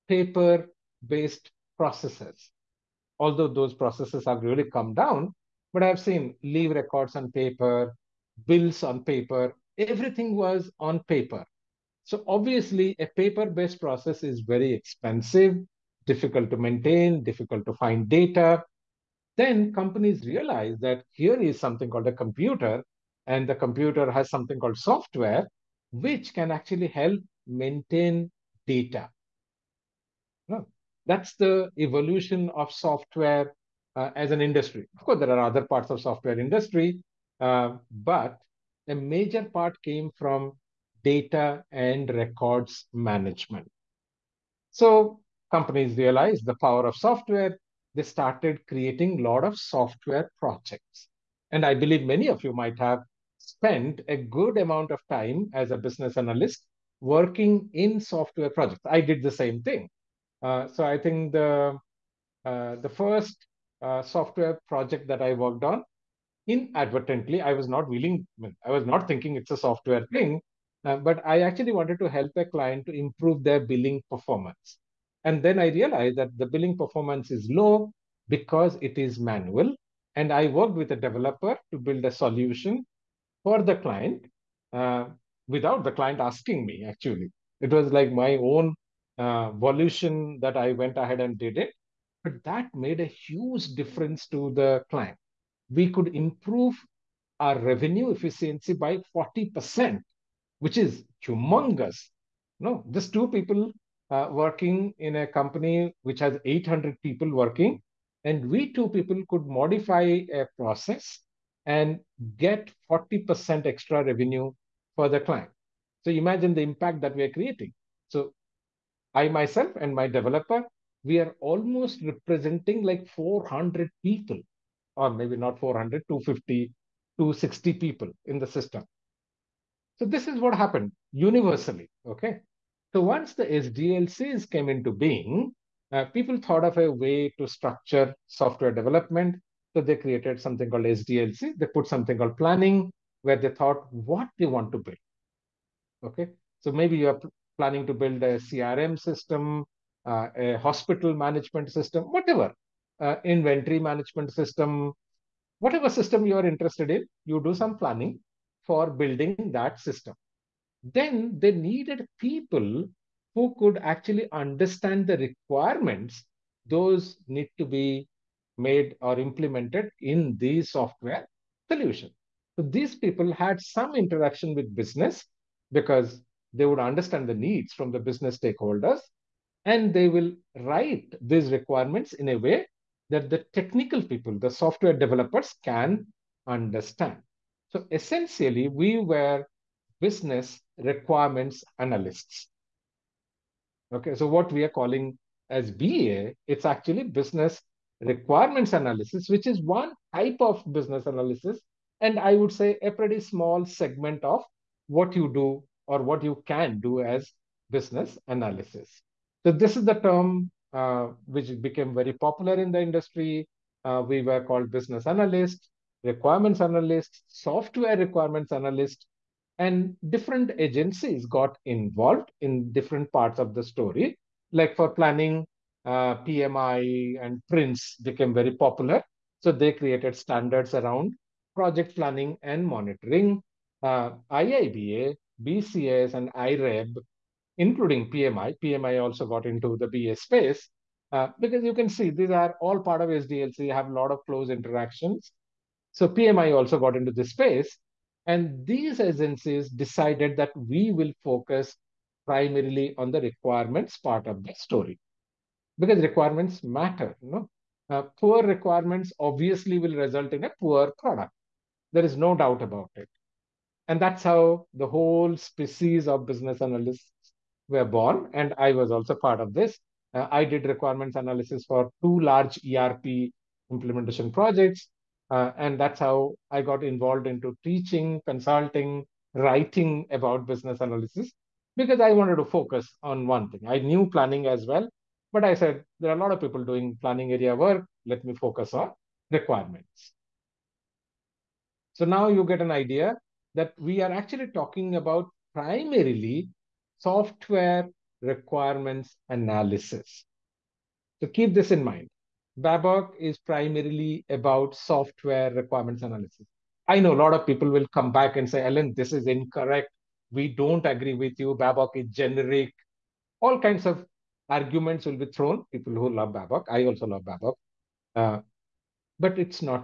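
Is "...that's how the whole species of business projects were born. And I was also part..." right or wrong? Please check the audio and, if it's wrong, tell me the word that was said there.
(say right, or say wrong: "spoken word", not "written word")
wrong: "analysts", not "projects".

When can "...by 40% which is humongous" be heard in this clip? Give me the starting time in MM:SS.
01:38.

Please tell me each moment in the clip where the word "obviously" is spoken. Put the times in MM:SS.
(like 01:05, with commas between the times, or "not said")
00:12, 04:19.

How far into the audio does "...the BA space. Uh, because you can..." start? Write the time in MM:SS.
03:59.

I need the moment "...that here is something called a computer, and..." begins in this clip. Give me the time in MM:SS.
00:20.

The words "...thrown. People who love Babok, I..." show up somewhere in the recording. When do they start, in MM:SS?
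05:15.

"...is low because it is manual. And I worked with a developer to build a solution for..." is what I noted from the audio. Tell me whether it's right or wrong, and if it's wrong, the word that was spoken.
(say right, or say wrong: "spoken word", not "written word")
right.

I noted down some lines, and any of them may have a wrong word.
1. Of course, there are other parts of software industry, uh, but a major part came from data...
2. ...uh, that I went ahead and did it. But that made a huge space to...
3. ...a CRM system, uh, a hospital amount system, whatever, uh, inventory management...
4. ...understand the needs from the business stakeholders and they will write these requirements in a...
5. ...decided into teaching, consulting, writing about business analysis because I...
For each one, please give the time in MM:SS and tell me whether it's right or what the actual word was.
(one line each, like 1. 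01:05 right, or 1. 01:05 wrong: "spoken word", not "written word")
1. 00:34 right
2. 01:29 wrong: "difference", not "space"
3. 02:28 wrong: "management", not "amount"
4. 02:56 right
5. 04:36 wrong: "involved", not "decided".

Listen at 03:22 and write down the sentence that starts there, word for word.
And I would say a pretty small segment of what you do or what you can do as business analysis.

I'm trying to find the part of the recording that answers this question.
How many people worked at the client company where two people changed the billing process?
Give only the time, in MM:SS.
01:46.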